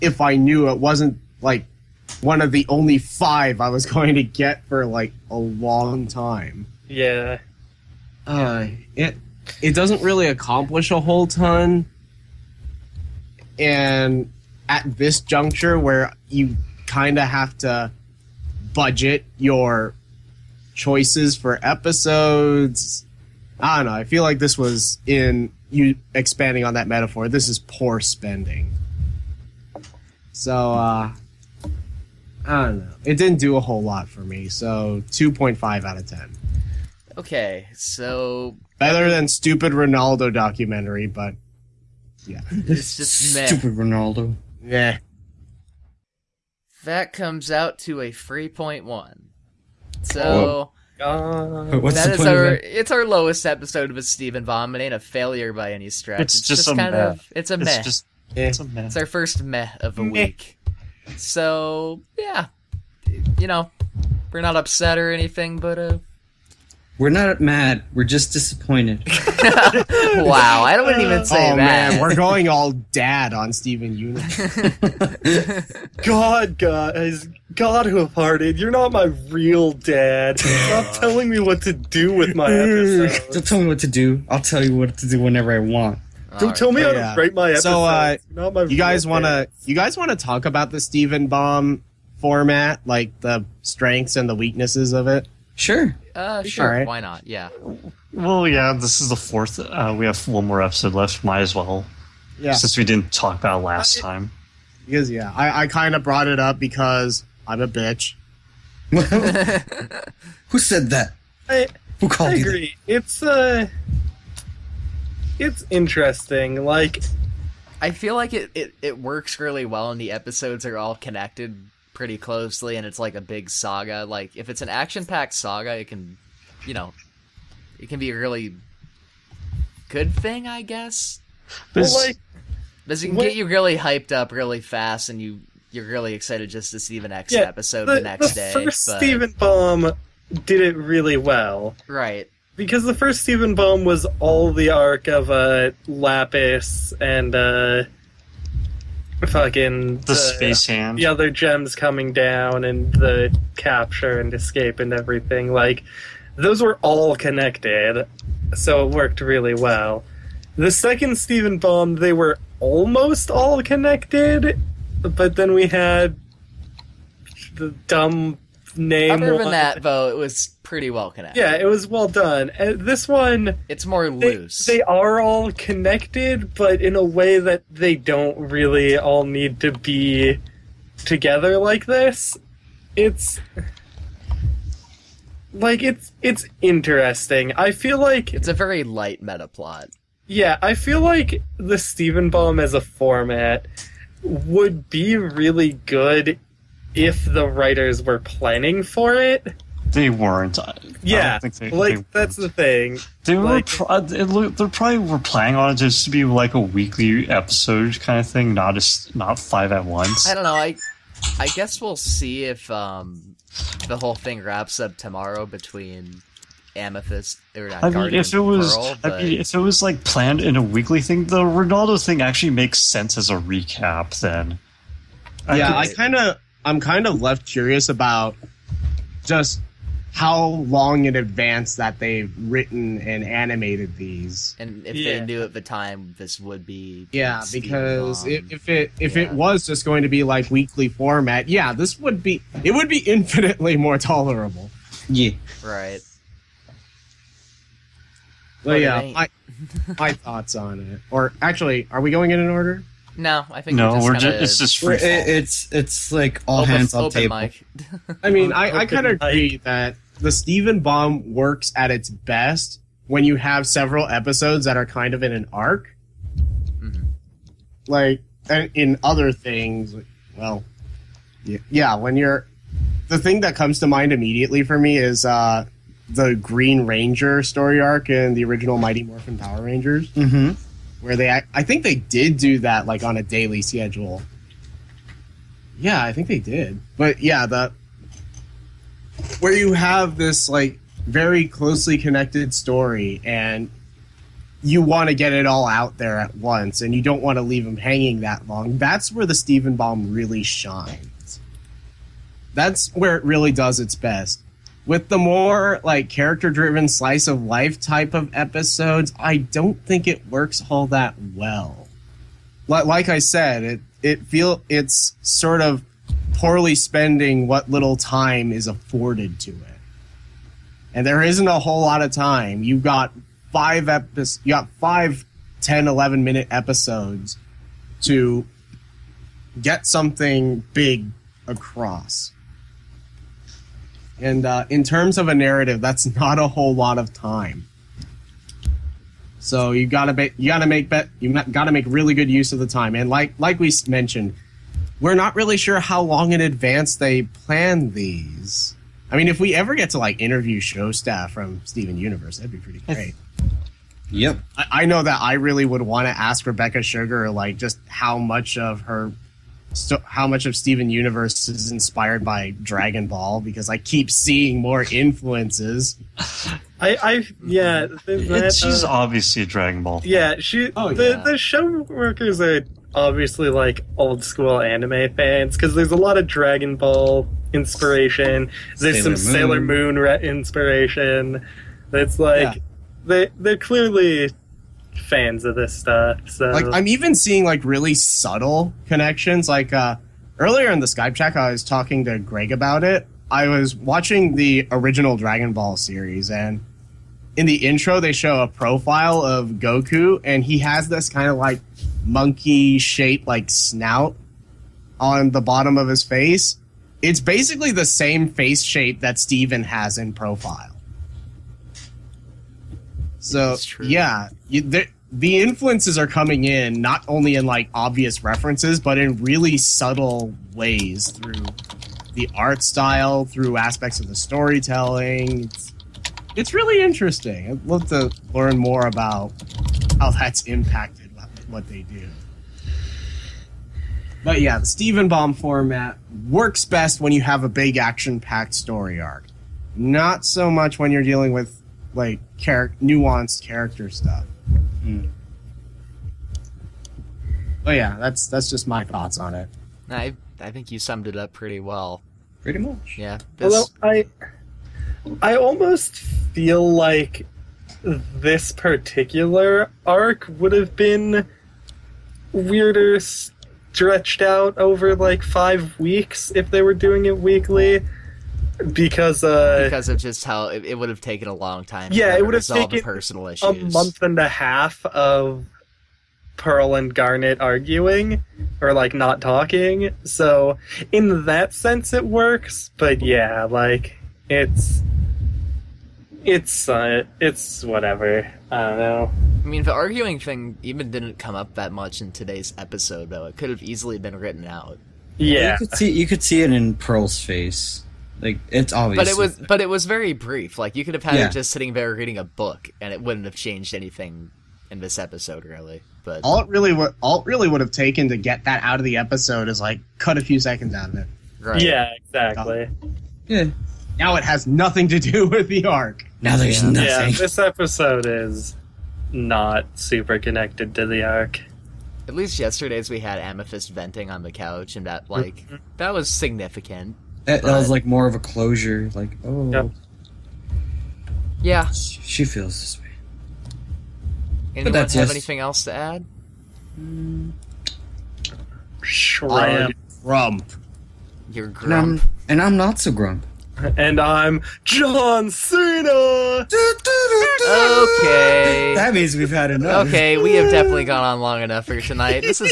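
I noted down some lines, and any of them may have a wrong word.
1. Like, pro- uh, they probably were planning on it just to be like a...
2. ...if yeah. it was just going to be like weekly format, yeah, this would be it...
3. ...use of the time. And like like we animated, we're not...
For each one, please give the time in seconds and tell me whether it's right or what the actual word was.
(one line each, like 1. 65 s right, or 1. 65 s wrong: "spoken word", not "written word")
1. 203 s right
2. 238 s right
3. 342 s wrong: "mentioned", not "animated".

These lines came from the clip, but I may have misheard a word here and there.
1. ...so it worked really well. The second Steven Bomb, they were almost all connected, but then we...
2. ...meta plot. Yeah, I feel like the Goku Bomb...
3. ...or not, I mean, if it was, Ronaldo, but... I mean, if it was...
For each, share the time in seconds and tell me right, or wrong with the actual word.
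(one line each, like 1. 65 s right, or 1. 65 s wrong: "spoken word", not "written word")
1. 158 s right
2. 189 s wrong: "Steven", not "Goku"
3. 217 s wrong: "Pearl", not "Ronaldo".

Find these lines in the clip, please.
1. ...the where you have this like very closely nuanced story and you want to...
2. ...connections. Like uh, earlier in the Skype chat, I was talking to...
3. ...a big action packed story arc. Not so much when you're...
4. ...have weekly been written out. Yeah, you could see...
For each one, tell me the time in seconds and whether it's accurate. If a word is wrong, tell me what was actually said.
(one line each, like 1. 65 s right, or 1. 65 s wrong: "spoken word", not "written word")
1. 287 s wrong: "connected", not "nuanced"
2. 388 s right
3. 437 s right
4. 493 s wrong: "easily", not "weekly".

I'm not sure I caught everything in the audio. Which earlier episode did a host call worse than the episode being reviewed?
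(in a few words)
Ronaldo documentary.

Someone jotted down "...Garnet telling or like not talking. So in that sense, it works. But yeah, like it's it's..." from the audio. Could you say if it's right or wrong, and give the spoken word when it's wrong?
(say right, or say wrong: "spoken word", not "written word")
wrong: "arguing", not "telling".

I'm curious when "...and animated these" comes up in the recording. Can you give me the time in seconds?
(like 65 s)
233 s.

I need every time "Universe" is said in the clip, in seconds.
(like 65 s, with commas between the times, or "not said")
73 s, 351 s, 360 s.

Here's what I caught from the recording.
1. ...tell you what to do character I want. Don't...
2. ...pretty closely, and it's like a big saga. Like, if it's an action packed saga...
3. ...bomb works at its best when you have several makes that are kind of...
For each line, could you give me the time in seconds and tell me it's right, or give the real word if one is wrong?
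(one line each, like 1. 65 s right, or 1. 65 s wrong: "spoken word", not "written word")
1. 84 s wrong: "whenever", not "character"
2. 121 s right
3. 260 s wrong: "episodes", not "makes".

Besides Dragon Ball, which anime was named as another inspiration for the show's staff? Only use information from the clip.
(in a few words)
Sailor Moon.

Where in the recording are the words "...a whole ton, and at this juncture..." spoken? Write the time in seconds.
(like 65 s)
10 s.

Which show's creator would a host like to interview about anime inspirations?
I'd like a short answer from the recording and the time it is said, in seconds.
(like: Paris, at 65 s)
Rebecca Sugar, at 356 s.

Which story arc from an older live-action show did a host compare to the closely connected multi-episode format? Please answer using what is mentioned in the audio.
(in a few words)
Green Ranger.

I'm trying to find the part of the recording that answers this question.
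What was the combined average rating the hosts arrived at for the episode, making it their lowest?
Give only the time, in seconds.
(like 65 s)
48 s.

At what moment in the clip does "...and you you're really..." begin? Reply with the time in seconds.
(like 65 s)
135 s.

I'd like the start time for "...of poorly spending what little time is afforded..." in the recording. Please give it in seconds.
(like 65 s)
315 s.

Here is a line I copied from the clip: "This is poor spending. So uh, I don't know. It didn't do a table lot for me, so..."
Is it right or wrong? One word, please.
wrong.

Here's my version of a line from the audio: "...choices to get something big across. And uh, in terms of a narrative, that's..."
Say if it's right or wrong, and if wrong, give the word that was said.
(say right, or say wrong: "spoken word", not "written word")
wrong: "episodes", not "choices".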